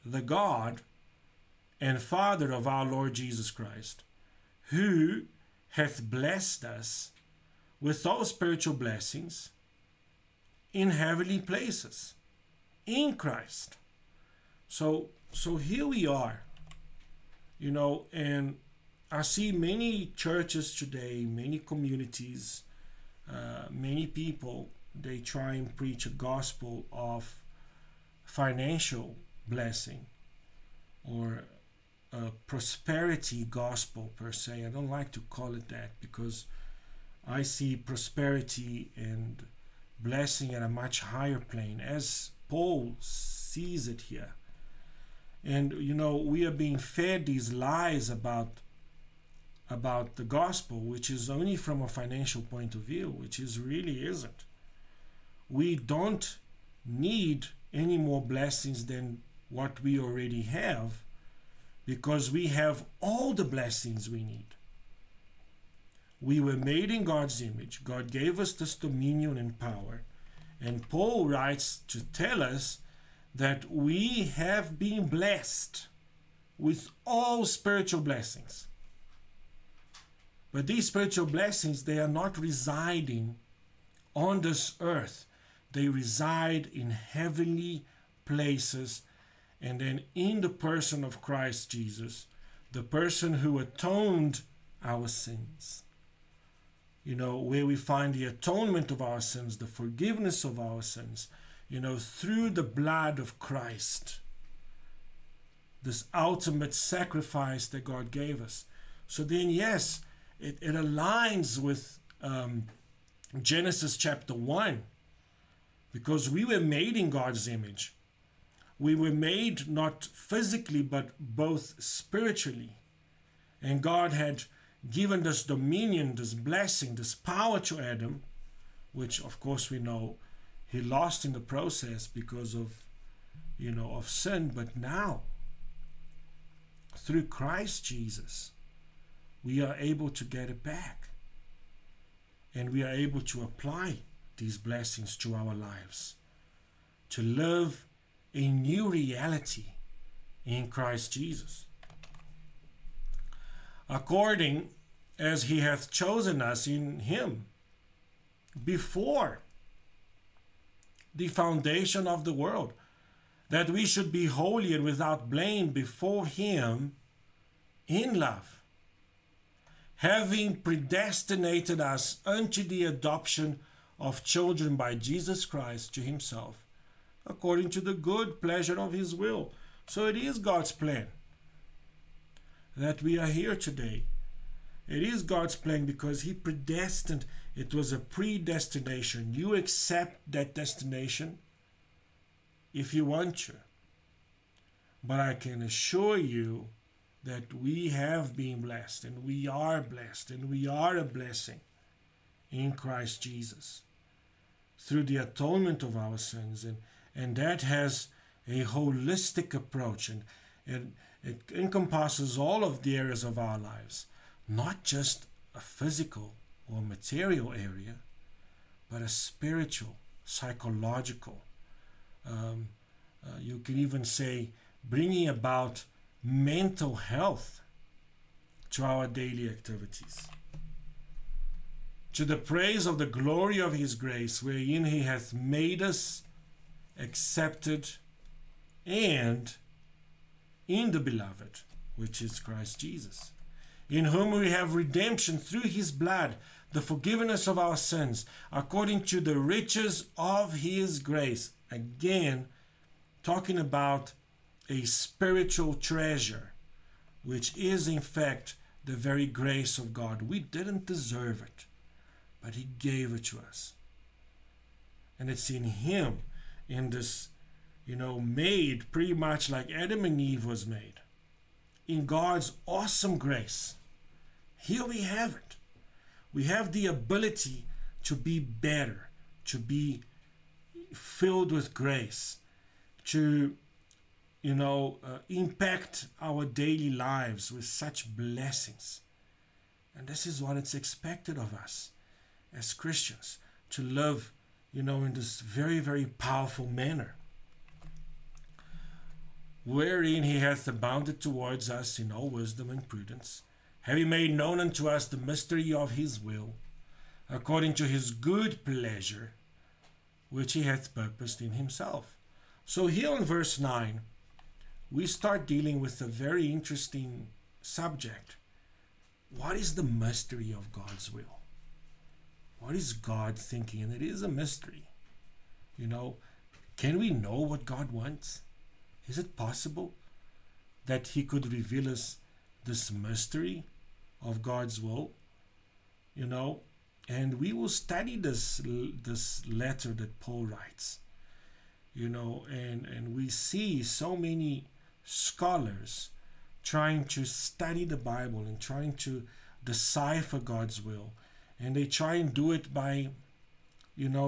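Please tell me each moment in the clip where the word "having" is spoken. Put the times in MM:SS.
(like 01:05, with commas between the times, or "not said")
02:49, 05:03.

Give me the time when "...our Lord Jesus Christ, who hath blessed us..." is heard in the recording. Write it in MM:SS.
00:02.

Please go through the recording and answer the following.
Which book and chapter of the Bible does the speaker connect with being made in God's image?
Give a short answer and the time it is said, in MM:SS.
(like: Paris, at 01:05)
Genesis chapter 1, at 01:53.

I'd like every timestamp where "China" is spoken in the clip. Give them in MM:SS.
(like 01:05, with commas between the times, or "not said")
not said.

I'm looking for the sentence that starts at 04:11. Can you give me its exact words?
Again, talking about a spiritual treasure, which is in fact the very grace of God.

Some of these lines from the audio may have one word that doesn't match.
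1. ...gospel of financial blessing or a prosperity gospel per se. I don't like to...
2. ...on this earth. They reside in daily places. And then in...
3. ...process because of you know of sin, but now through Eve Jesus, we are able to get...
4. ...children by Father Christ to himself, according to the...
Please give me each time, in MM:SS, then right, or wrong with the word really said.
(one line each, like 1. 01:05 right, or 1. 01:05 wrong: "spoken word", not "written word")
1. 00:26 right
2. 01:24 wrong: "heavenly", not "daily"
3. 02:11 wrong: "Christ", not "Eve"
4. 02:54 wrong: "Jesus", not "Father".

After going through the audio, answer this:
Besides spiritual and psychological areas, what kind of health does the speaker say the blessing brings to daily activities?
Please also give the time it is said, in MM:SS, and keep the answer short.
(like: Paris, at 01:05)
mental health, at 03:46.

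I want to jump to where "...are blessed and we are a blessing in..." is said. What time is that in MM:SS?
03:19.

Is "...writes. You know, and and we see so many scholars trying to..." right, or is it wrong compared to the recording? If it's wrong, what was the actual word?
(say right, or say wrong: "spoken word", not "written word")
right.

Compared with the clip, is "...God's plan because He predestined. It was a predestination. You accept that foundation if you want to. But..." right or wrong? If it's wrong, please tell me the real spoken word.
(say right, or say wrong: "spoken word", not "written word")
wrong: "destination", not "foundation".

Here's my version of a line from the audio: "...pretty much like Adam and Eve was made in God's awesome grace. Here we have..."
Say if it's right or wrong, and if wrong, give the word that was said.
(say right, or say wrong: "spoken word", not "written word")
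right.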